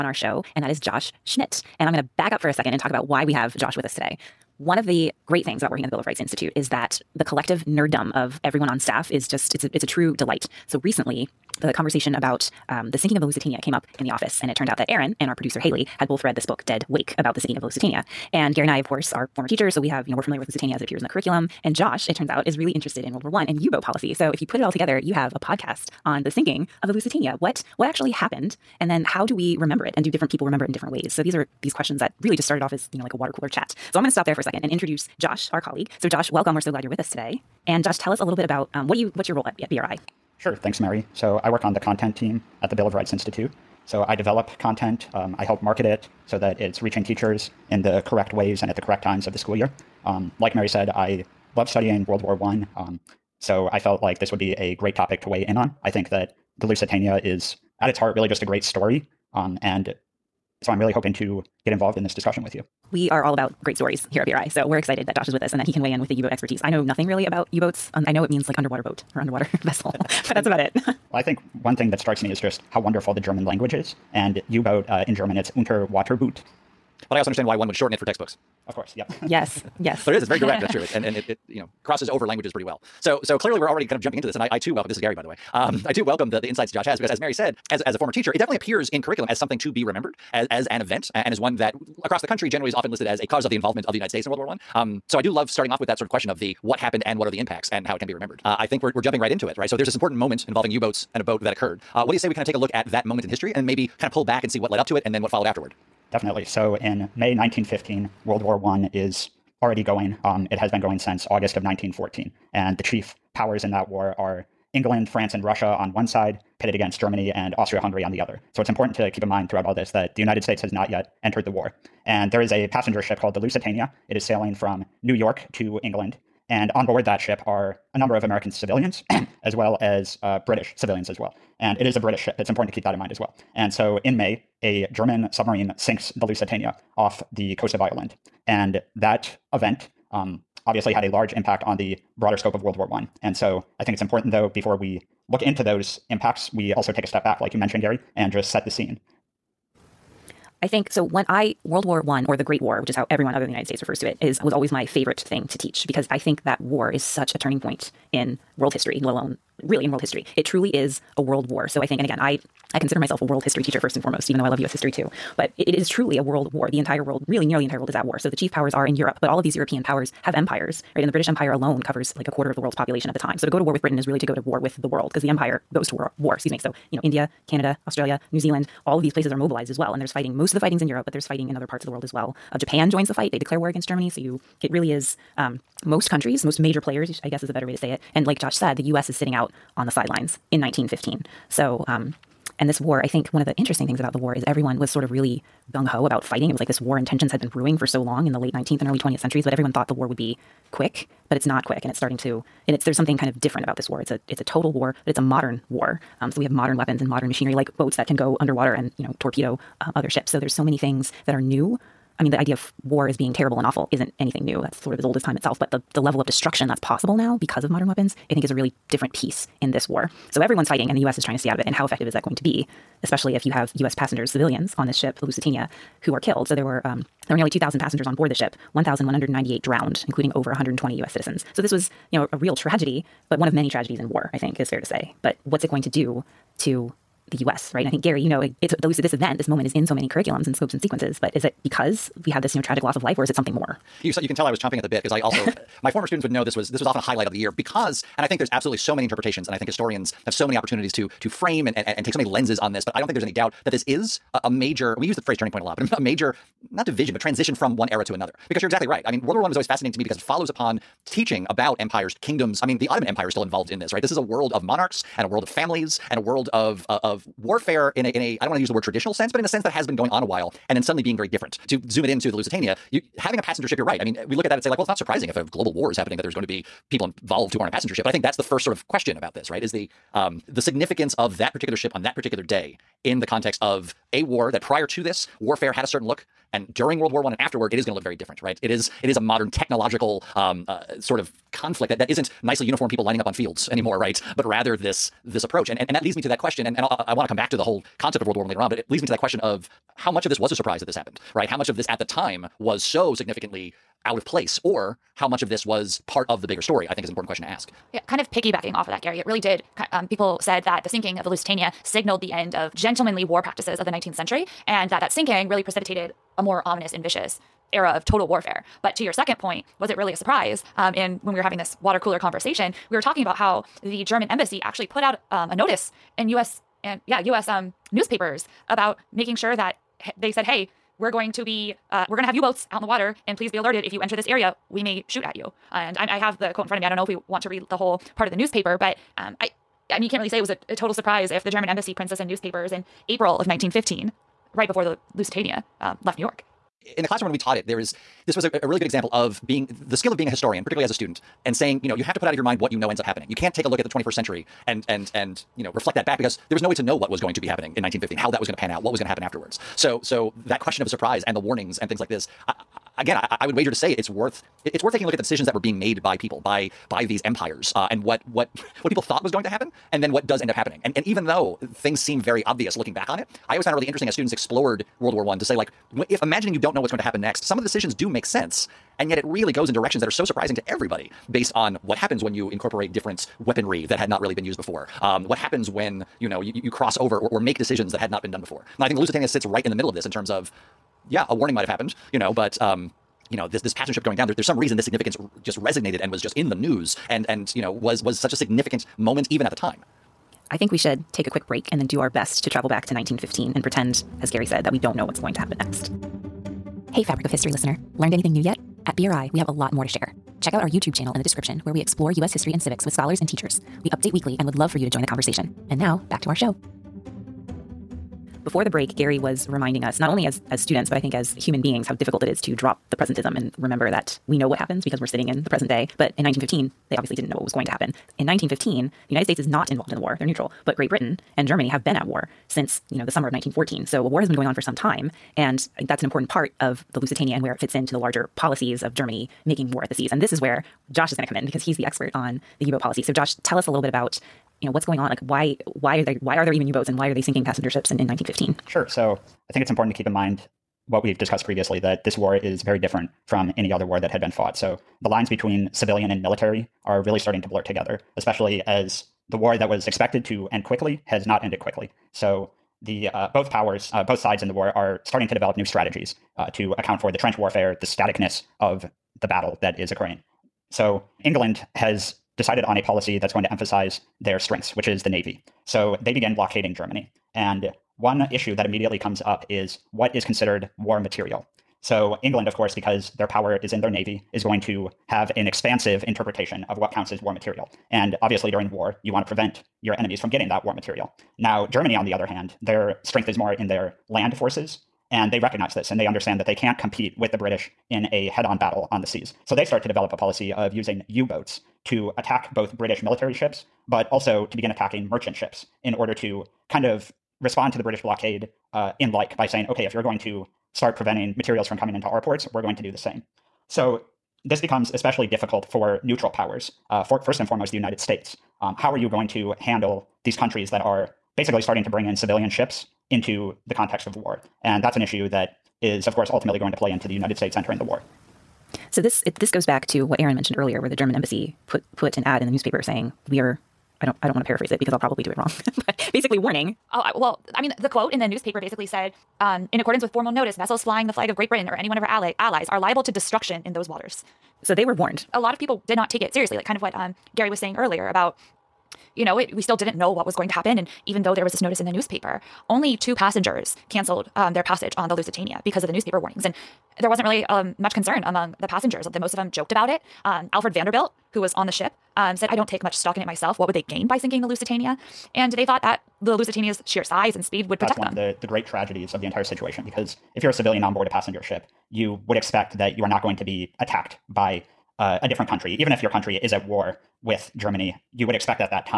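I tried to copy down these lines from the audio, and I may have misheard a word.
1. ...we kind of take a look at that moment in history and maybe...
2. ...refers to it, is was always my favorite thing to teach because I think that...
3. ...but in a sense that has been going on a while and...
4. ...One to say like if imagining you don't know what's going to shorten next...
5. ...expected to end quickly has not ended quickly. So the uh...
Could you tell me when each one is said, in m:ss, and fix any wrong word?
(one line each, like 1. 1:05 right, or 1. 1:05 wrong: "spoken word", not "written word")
1. 1:42 right
2. 2:33 right
3. 4:29 right
4. 6:15 wrong: "happen", not "shorten"
5. 7:39 right.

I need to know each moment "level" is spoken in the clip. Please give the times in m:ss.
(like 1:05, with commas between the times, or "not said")
3:36.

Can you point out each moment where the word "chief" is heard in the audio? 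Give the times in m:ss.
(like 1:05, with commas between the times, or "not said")
1:52, 2:48.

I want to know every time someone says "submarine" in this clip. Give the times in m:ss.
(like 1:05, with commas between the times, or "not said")
2:15.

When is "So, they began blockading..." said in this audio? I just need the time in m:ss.
7:55.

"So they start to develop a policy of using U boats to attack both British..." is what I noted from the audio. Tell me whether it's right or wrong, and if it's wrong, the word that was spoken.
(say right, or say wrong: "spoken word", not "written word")
right.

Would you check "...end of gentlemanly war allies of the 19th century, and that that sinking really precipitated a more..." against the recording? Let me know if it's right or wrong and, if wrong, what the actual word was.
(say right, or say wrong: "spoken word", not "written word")
wrong: "practices", not "allies".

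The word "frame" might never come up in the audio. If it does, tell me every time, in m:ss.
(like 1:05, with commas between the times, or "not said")
4:11.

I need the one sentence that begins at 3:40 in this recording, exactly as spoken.
So everyone's fighting, and the US is trying to stay out of it.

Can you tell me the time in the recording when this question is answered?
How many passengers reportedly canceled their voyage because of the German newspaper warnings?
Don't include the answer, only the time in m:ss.
9:12.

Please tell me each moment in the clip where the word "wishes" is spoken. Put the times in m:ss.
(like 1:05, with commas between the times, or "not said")
not said.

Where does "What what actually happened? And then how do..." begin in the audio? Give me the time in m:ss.
0:27.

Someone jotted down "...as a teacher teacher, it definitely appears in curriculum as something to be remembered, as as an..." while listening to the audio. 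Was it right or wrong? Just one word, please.
wrong.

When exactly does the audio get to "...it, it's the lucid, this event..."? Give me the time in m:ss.
3:58.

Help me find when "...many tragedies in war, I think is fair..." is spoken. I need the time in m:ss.
3:53.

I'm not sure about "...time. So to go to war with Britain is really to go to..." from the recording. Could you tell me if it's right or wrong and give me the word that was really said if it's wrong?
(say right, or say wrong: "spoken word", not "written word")
right.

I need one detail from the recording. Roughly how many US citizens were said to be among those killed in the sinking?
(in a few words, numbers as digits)
over 120.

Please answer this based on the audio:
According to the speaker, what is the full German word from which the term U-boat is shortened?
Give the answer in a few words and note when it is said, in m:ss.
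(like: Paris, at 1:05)
Unterwaterboot, at 1:15.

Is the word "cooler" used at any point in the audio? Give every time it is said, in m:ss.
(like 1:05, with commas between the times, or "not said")
0:33, 5:21.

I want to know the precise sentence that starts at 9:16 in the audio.
And there wasn't really um, much concern among the passengers.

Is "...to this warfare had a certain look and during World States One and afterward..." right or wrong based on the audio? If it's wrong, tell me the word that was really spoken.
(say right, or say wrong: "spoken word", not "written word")
wrong: "War", not "States".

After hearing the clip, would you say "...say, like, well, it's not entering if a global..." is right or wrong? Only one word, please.
wrong.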